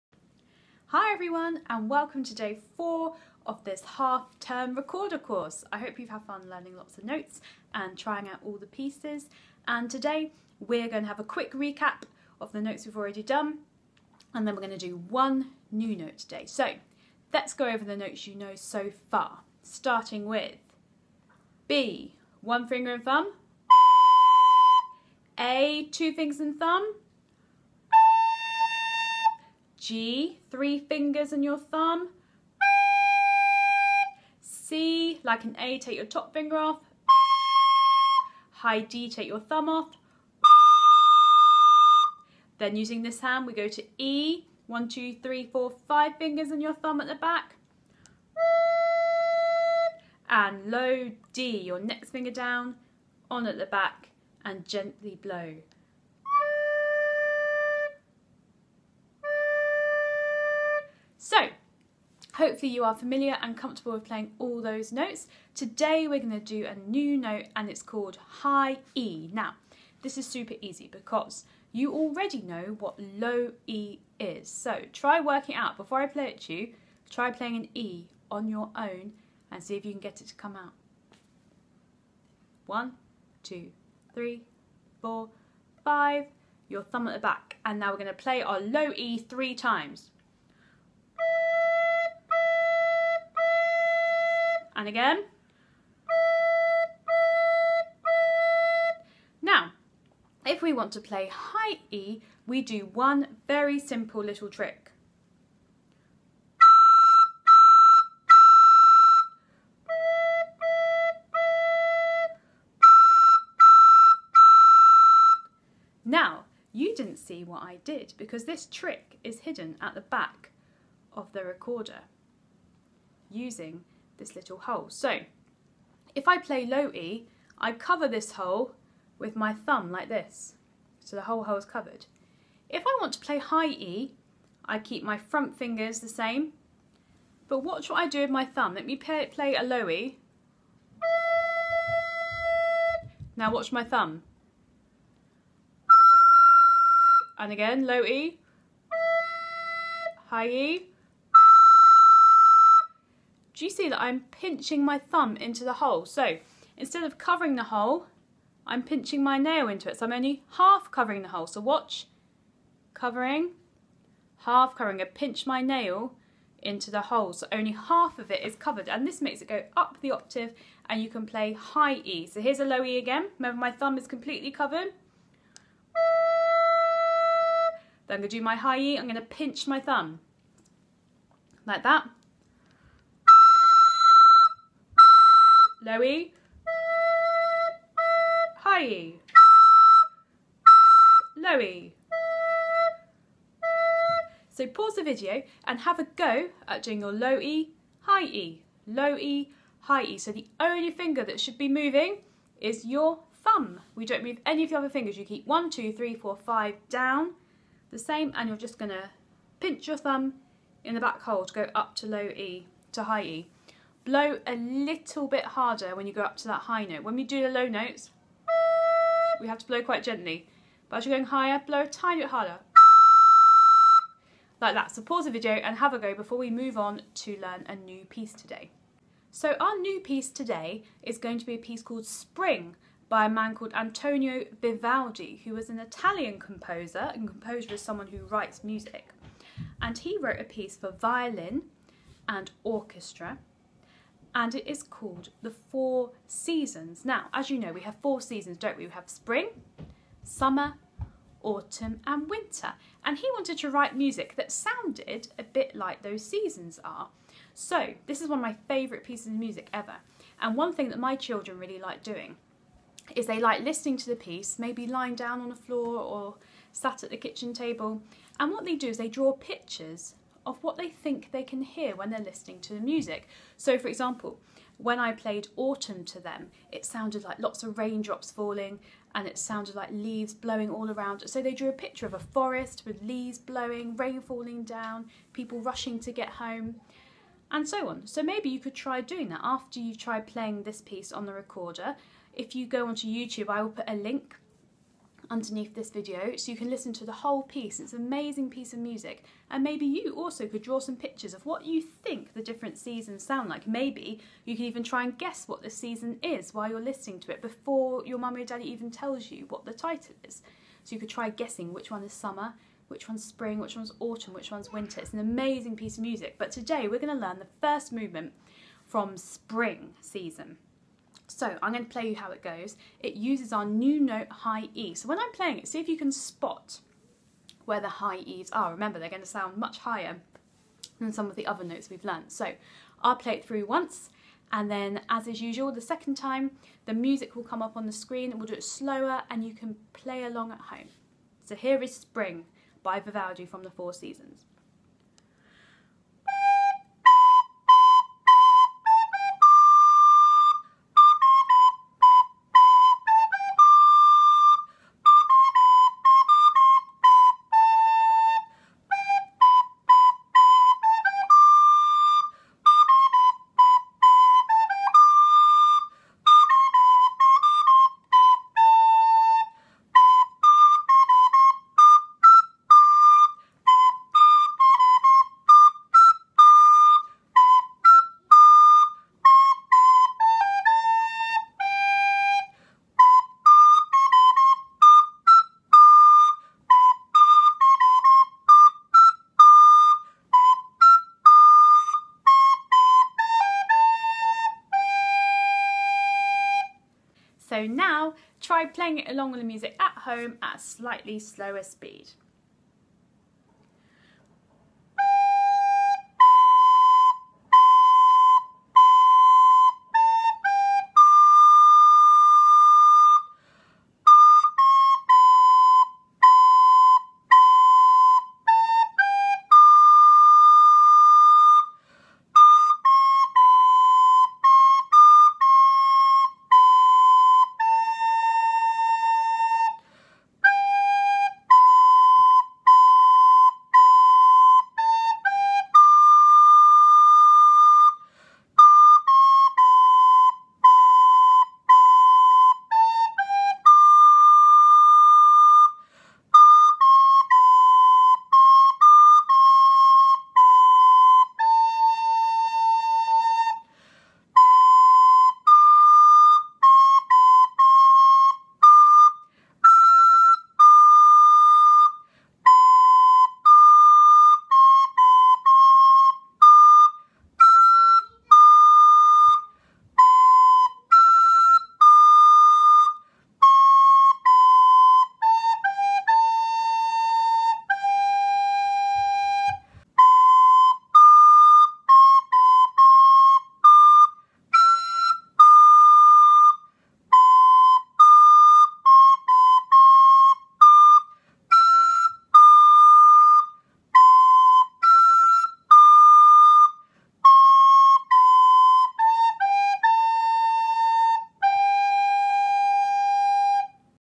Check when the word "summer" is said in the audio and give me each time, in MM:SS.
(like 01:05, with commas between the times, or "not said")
04:10, 05:12.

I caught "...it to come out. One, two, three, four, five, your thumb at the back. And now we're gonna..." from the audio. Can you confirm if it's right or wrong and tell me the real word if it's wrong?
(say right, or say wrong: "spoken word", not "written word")
right.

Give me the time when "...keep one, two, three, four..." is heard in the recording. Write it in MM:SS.
03:25.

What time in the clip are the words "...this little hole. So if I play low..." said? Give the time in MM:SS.
02:04.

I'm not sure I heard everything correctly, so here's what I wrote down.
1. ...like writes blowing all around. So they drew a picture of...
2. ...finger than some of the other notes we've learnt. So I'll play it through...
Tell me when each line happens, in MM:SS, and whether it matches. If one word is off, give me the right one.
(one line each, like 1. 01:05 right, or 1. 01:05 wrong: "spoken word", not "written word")
1. 04:39 wrong: "leaves", not "writes"
2. 05:29 wrong: "higher", not "finger".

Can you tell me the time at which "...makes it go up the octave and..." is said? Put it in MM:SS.
02:49.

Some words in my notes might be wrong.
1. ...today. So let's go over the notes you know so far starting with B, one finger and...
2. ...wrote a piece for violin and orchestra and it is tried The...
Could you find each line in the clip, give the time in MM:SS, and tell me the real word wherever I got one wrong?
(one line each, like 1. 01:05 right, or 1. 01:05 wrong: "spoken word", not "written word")
1. 00:16 right
2. 04:00 wrong: "called", not "tried".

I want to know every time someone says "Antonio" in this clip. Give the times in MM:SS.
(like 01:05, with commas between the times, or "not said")
03:53.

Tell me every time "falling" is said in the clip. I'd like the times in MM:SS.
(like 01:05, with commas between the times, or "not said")
04:38, 04:44.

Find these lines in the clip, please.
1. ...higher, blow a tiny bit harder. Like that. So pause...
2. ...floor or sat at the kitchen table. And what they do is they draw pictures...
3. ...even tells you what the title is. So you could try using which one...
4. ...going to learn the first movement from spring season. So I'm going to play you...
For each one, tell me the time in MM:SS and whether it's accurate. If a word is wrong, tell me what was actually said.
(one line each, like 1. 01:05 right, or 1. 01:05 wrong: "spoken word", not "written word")
1. 03:41 right
2. 04:25 right
3. 05:08 wrong: "guessing", not "using"
4. 05:16 right.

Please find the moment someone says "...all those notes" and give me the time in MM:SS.
01:04.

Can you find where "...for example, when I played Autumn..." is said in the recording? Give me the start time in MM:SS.
04:33.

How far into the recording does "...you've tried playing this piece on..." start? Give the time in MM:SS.
04:49.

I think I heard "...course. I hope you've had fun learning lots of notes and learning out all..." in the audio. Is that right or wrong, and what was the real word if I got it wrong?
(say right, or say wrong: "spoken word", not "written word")
wrong: "trying", not "learning".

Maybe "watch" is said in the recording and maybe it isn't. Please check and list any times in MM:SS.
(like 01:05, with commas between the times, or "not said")
02:17, 02:23, 02:41.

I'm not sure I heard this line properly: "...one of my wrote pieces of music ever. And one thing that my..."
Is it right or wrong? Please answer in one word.
wrong.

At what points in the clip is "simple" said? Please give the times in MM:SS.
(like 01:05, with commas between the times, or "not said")
01:43.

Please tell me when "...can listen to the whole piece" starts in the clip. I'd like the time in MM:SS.
04:56.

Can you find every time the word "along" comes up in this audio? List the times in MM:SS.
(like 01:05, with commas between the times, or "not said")
05:40, 06:39.